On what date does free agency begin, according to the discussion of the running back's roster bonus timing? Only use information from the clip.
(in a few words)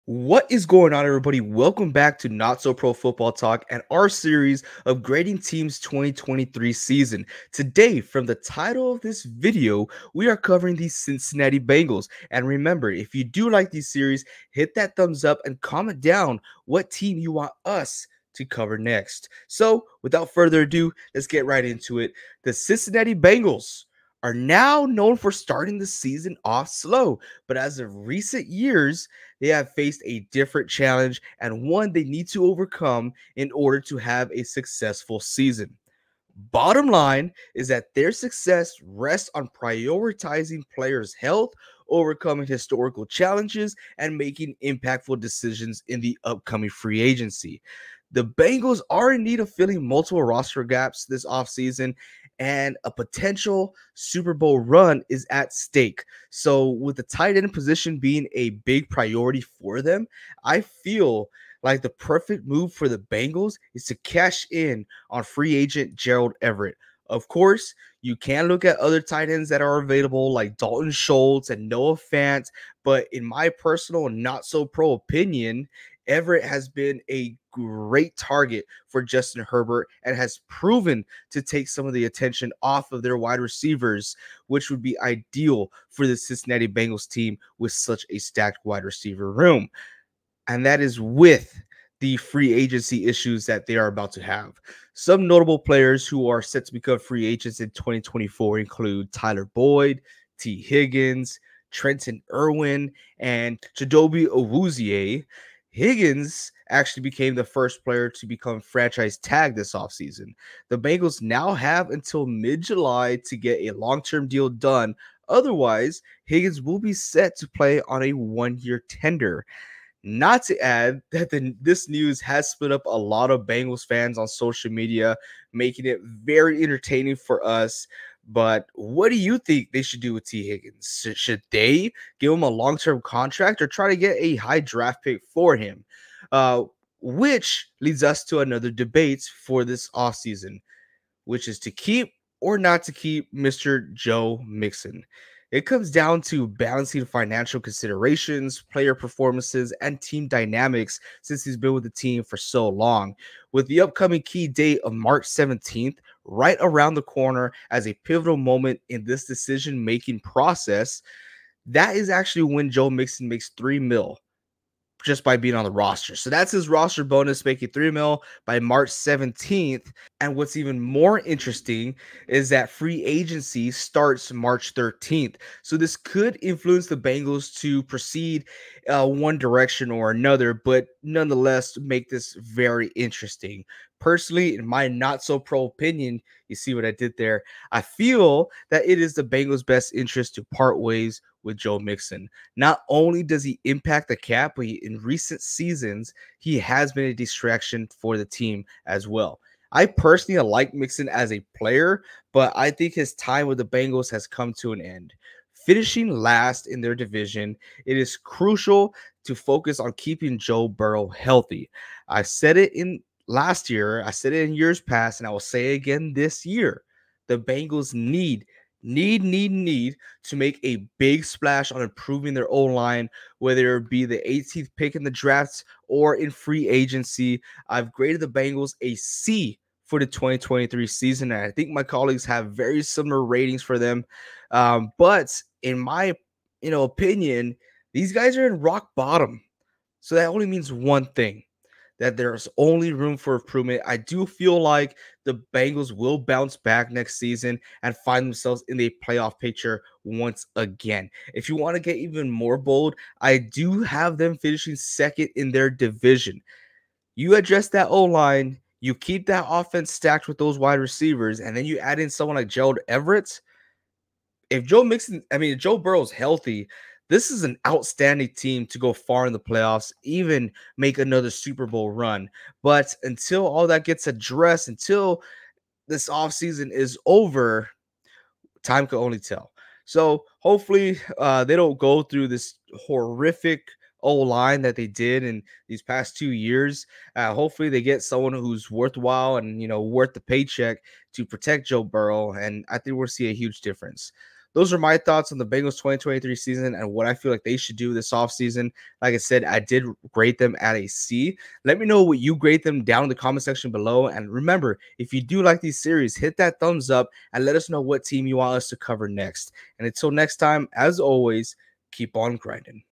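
March 13.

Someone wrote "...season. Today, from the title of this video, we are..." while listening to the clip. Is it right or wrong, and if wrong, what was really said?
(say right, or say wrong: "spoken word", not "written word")
right.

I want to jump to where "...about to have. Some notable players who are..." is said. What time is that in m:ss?
1:33.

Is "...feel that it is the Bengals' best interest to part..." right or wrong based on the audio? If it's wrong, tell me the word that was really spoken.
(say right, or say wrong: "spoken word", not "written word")
right.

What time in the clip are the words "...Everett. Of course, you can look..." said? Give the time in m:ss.
1:06.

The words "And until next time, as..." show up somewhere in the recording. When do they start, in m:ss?
5:09.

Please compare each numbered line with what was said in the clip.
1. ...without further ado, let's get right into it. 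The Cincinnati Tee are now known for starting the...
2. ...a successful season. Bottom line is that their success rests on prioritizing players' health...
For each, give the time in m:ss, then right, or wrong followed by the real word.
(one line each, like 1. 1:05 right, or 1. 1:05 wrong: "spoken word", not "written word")
1. 0:20 wrong: "Bengals", not "Tee"
2. 0:34 right.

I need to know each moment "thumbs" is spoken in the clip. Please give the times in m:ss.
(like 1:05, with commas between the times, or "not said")
0:14, 5:06.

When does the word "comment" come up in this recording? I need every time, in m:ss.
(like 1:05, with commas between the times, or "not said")
0:15, 5:03.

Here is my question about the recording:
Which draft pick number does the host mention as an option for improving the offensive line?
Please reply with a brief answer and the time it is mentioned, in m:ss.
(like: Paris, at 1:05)
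18, at 3:44.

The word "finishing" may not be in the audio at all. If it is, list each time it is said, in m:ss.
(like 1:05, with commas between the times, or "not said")
3:25, 4:14.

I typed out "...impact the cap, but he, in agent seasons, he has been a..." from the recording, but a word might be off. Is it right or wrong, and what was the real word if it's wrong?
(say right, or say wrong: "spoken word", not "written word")
wrong: "recent", not "agent".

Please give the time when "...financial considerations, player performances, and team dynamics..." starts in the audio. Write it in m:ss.
2:27.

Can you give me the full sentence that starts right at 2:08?
But what do you think they should do with Tee Higgins?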